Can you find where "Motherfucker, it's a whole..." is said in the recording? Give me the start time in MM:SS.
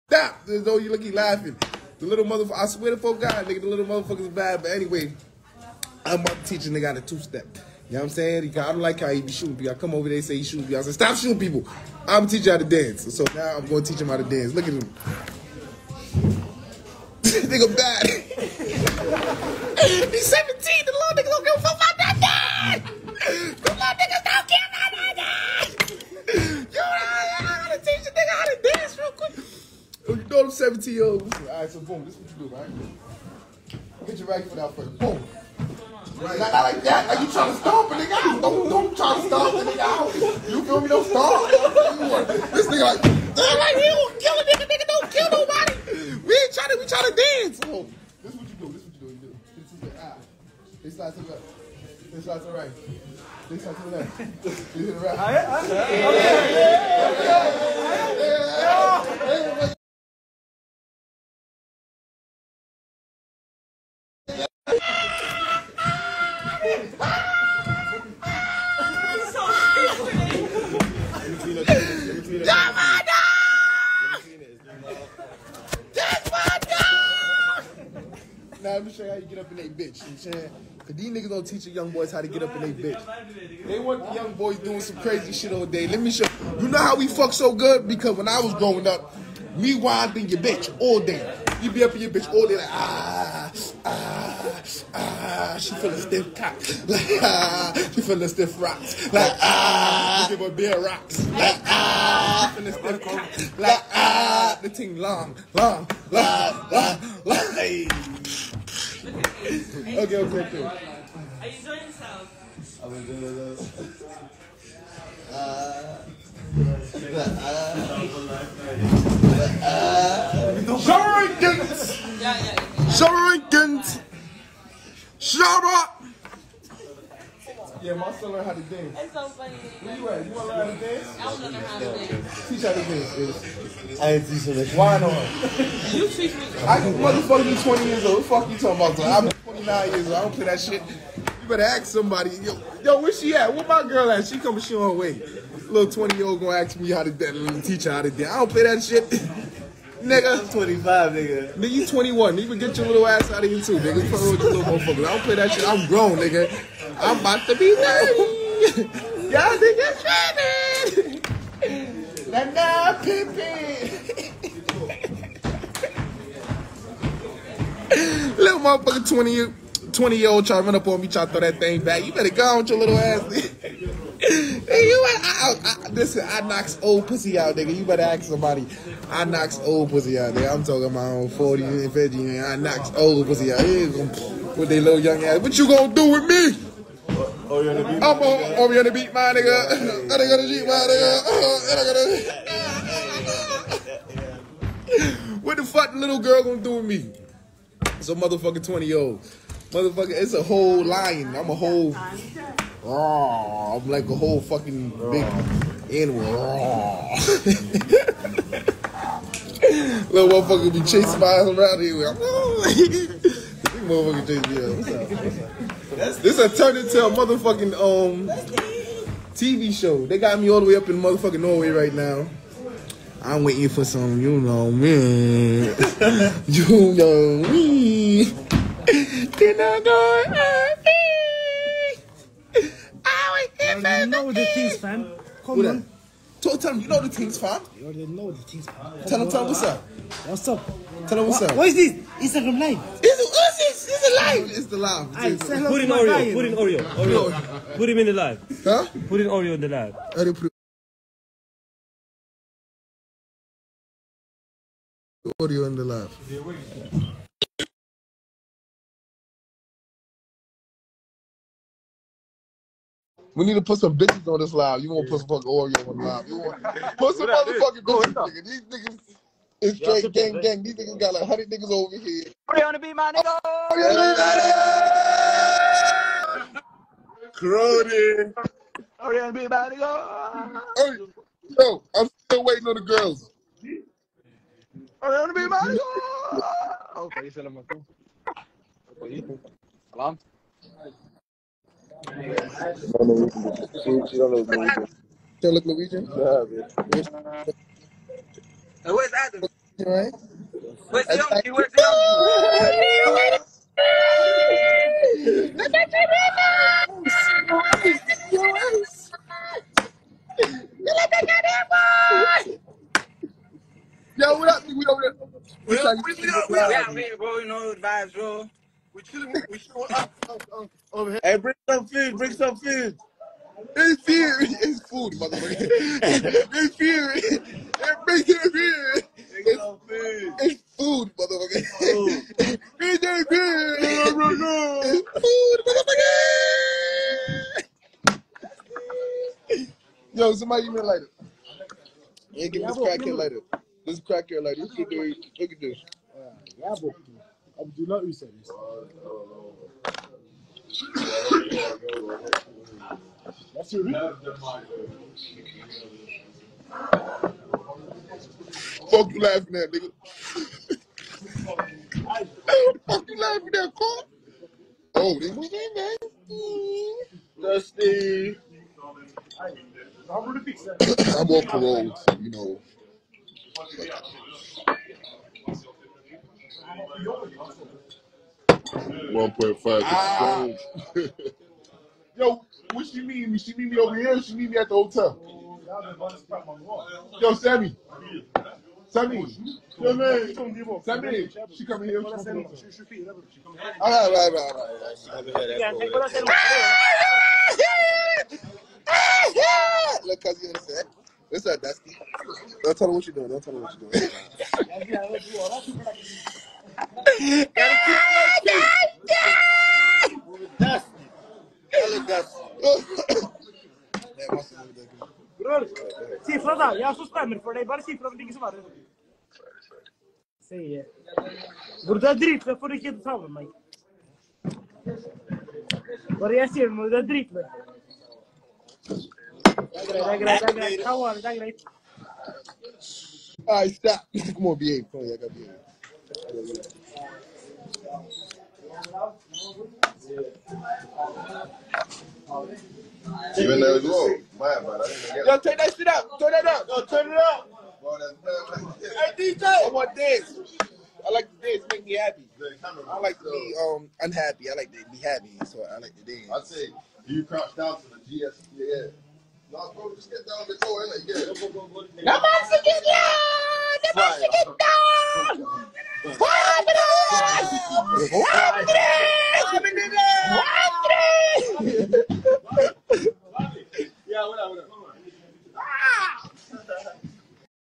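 03:19.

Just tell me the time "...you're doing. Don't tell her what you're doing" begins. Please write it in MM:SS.
06:43.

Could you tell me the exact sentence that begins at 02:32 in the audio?
Even get your little ass out of here too, nigga.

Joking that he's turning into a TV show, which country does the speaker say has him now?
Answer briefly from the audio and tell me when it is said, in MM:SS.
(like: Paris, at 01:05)
Norway, at 03:41.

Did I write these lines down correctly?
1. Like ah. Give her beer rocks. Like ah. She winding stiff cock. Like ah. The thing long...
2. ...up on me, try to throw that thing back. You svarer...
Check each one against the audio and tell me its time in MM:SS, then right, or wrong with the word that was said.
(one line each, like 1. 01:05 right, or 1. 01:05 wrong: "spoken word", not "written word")
1. 01:39 wrong: "feeling", not "winding"
2. 02:50 wrong: "better", not "svarer".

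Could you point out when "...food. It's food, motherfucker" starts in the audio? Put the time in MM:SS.
05:29.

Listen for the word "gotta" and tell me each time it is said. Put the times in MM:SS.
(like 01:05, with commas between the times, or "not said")
03:10, 03:14.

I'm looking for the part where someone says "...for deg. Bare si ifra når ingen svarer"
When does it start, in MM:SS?
06:57.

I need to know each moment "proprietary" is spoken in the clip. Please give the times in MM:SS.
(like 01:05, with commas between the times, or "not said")
not said.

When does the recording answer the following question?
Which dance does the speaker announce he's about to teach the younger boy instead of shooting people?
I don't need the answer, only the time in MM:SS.
00:07.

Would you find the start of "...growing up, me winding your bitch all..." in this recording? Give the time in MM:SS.
01:28.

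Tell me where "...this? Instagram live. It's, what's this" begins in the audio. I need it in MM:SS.
04:01.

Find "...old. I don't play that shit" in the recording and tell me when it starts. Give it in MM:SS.
02:20.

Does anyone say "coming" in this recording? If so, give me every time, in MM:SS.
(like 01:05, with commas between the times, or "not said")
02:24, 06:31.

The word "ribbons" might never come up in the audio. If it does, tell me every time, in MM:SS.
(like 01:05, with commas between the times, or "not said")
05:06, 05:11.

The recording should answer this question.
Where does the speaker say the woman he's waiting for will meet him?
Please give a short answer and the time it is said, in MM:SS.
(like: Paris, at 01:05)
at the hotel, at 06:24.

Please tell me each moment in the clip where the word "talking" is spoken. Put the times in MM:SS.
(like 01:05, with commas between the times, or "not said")
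02:18, 03:00.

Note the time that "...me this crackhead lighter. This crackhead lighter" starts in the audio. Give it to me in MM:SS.
05:42.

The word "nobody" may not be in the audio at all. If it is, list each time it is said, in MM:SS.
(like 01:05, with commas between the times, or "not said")
00:45, 07:42.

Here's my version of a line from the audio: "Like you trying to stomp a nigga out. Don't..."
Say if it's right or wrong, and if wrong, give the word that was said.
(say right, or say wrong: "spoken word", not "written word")
right.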